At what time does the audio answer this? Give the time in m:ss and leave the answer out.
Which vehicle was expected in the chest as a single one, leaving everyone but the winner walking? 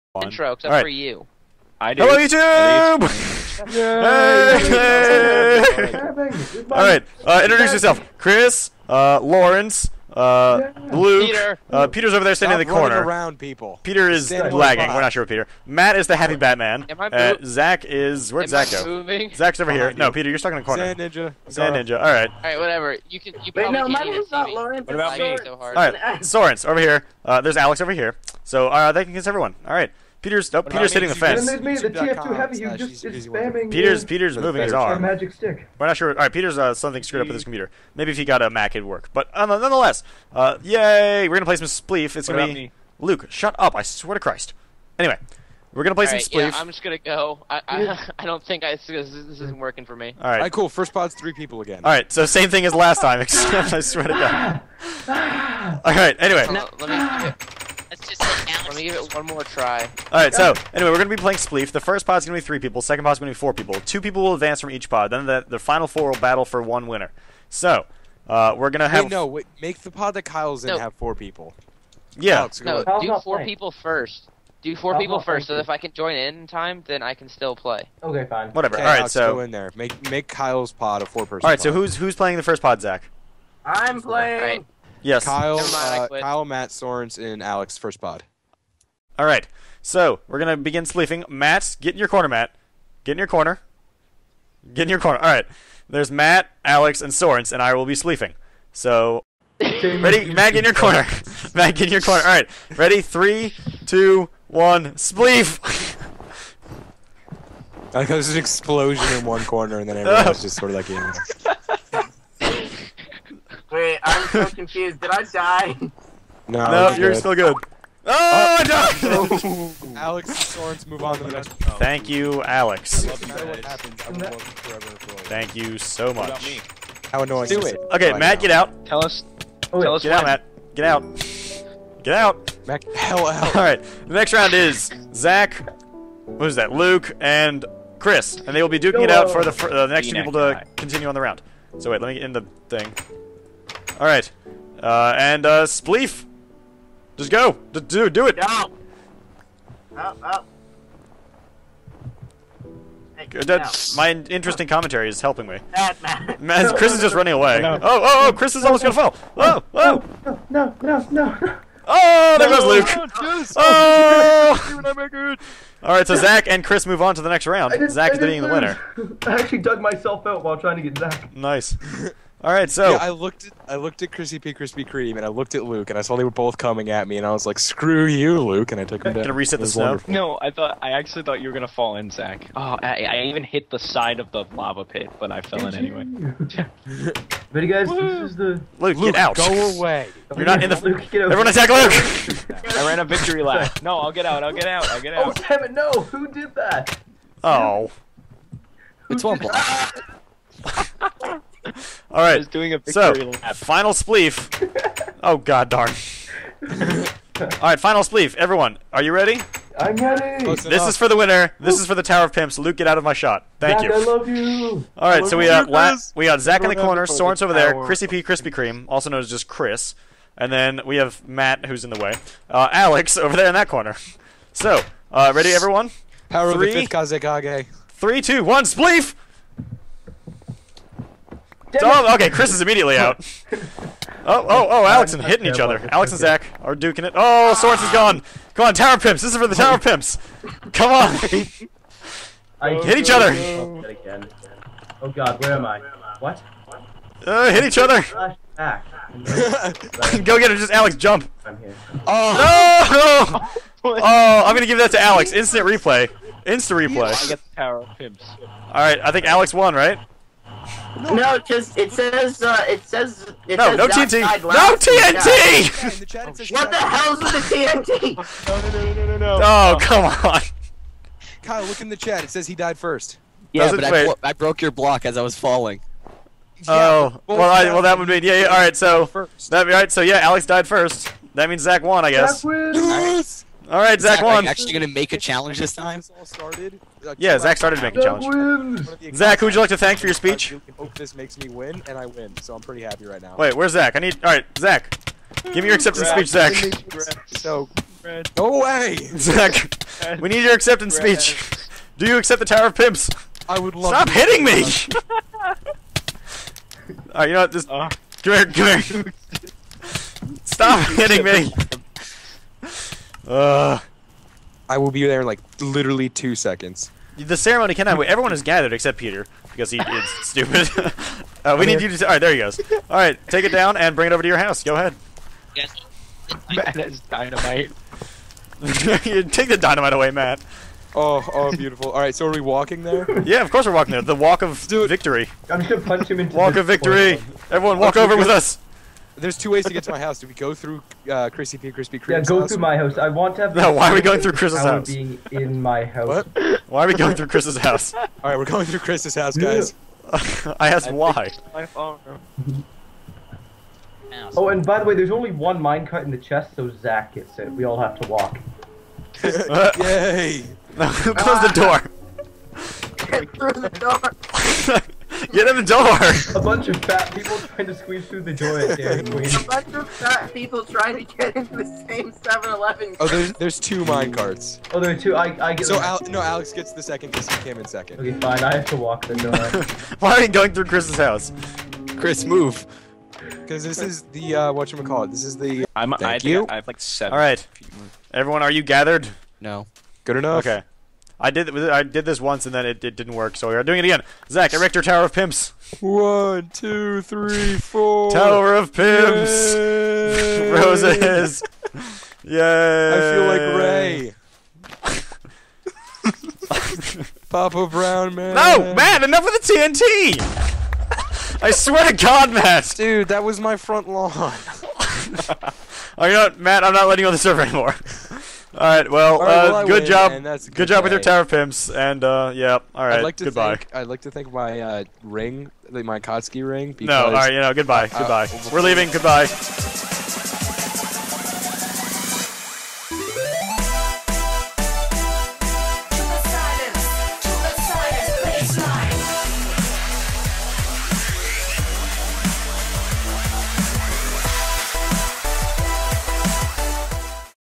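5:55.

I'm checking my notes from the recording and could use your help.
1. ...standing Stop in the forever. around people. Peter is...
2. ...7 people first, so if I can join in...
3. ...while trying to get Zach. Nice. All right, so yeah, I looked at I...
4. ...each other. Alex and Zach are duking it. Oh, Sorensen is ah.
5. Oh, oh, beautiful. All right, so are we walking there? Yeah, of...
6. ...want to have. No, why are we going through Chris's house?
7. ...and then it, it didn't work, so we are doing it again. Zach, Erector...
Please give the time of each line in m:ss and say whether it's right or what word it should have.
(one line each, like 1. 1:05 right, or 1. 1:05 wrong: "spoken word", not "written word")
1. 0:12 wrong: "corner", not "forever"
2. 1:14 wrong: "4", not "7"
3. 2:50 right
4. 3:55 right
5. 5:30 right
6. 5:43 right
7. 6:32 right.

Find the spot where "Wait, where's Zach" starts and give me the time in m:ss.
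4:53.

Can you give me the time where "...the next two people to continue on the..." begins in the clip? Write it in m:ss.
2:19.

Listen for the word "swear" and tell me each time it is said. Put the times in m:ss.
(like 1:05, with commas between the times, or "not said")
0:43, 0:53, 6:51.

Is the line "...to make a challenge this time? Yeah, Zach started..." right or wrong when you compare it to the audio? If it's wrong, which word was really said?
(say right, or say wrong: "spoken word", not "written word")
right.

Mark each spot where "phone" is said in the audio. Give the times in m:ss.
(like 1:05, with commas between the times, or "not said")
5:51.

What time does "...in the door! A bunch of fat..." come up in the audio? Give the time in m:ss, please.
6:05.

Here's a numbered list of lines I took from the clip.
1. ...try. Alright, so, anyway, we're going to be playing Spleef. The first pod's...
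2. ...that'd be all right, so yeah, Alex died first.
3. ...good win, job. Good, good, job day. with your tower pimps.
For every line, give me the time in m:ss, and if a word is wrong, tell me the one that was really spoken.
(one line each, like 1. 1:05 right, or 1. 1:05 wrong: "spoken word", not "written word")
1. 0:59 right
2. 4:39 right
3. 6:59 right.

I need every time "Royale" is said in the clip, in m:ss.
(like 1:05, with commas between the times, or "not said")
not said.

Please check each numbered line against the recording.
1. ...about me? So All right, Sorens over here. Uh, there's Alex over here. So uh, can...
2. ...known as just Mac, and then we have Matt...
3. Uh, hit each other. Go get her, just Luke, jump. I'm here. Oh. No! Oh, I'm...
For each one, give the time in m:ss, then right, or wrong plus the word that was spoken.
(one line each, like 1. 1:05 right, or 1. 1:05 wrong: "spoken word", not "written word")
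1. 0:24 right
2. 3:39 wrong: "Chris", not "Mac"
3. 4:07 wrong: "Alex", not "Luke".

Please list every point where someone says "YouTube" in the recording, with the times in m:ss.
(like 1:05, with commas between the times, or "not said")
0:02.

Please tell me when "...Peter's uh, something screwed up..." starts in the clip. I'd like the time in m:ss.
0:36.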